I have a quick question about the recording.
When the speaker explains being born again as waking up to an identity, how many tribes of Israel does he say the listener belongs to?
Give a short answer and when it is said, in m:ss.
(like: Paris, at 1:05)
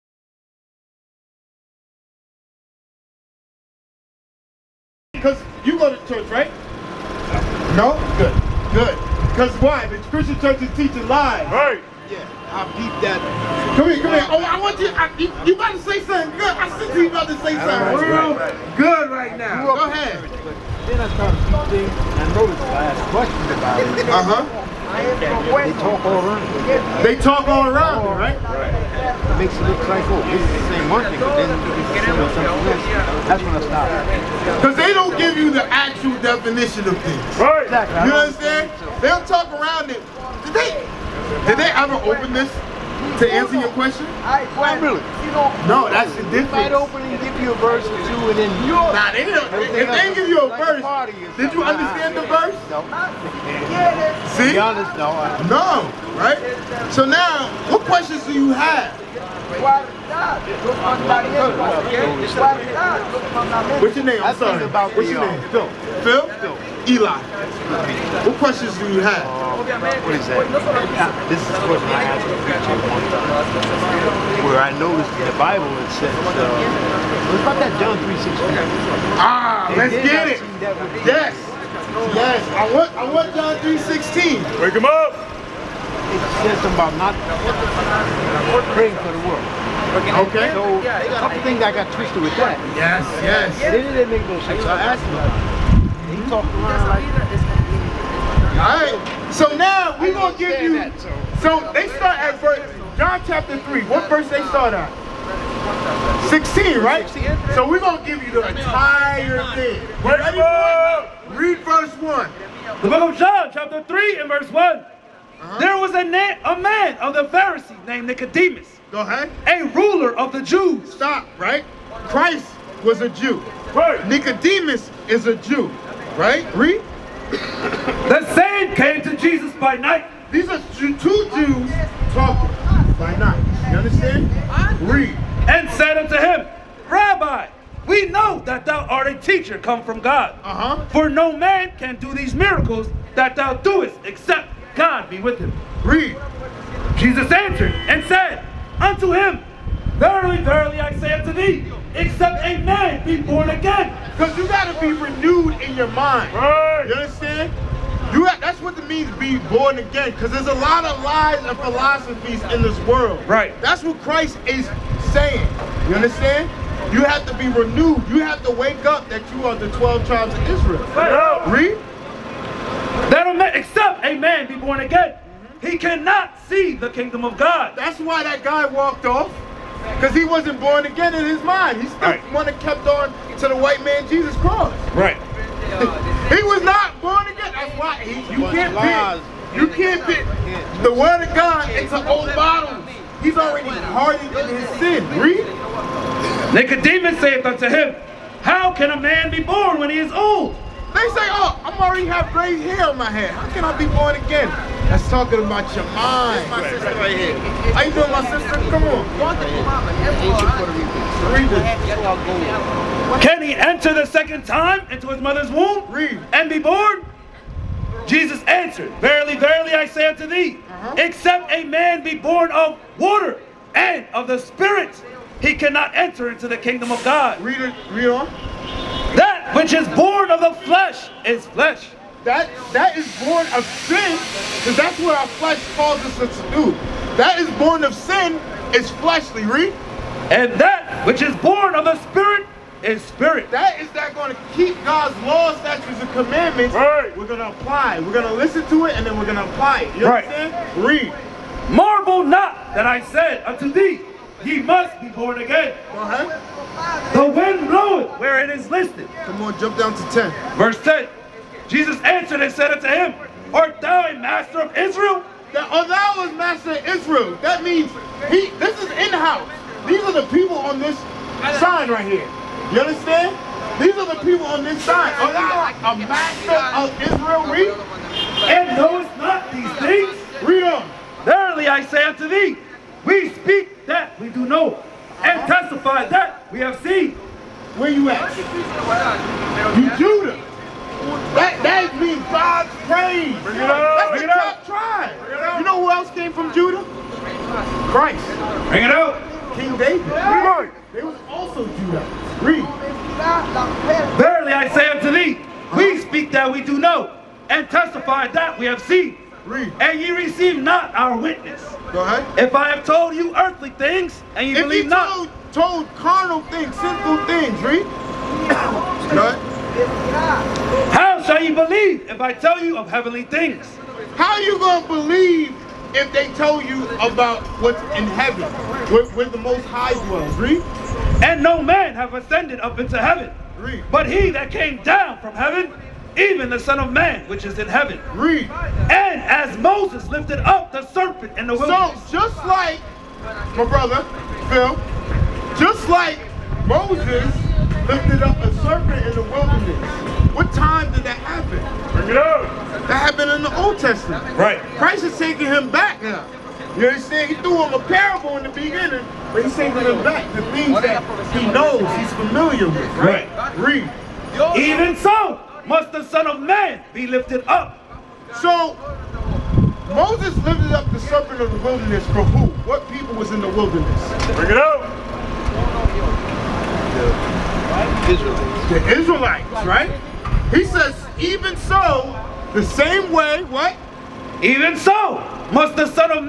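12, at 2:49.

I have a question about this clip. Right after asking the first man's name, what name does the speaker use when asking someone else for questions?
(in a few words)
Eli.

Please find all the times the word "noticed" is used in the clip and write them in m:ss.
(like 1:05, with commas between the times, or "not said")
0:22, 1:14.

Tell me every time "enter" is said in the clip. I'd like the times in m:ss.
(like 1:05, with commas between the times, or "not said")
3:33, 3:45.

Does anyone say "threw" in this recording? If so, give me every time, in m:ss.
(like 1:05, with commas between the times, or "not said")
5:57.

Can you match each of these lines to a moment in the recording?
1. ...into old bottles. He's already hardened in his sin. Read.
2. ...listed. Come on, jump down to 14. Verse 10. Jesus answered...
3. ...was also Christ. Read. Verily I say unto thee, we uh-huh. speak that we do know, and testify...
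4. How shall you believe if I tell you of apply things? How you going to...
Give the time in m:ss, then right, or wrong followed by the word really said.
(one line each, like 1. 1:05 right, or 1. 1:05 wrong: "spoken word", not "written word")
1. 3:11 right
2. 4:18 wrong: "10", not "14"
3. 5:01 wrong: "Judah", not "Christ"
4. 5:20 wrong: "heavenly", not "apply".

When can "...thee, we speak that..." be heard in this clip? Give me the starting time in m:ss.
4:42.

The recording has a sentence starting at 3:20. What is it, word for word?
They say, oh, I'm already have gray hair on my head.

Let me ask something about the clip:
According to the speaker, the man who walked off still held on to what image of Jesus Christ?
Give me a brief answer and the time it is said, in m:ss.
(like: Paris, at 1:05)
white man Jesus Christ, at 3:03.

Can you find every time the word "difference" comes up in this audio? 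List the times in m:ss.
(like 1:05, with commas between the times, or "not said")
0:46.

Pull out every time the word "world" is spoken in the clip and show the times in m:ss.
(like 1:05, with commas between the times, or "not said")
1:29, 2:42.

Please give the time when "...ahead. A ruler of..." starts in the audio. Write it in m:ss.
1:59.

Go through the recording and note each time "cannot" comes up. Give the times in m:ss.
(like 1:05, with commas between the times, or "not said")
2:55, 3:45.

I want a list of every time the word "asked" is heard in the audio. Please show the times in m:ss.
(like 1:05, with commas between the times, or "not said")
0:22, 1:12, 1:34.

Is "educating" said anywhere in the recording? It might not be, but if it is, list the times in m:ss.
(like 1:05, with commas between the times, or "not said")
not said.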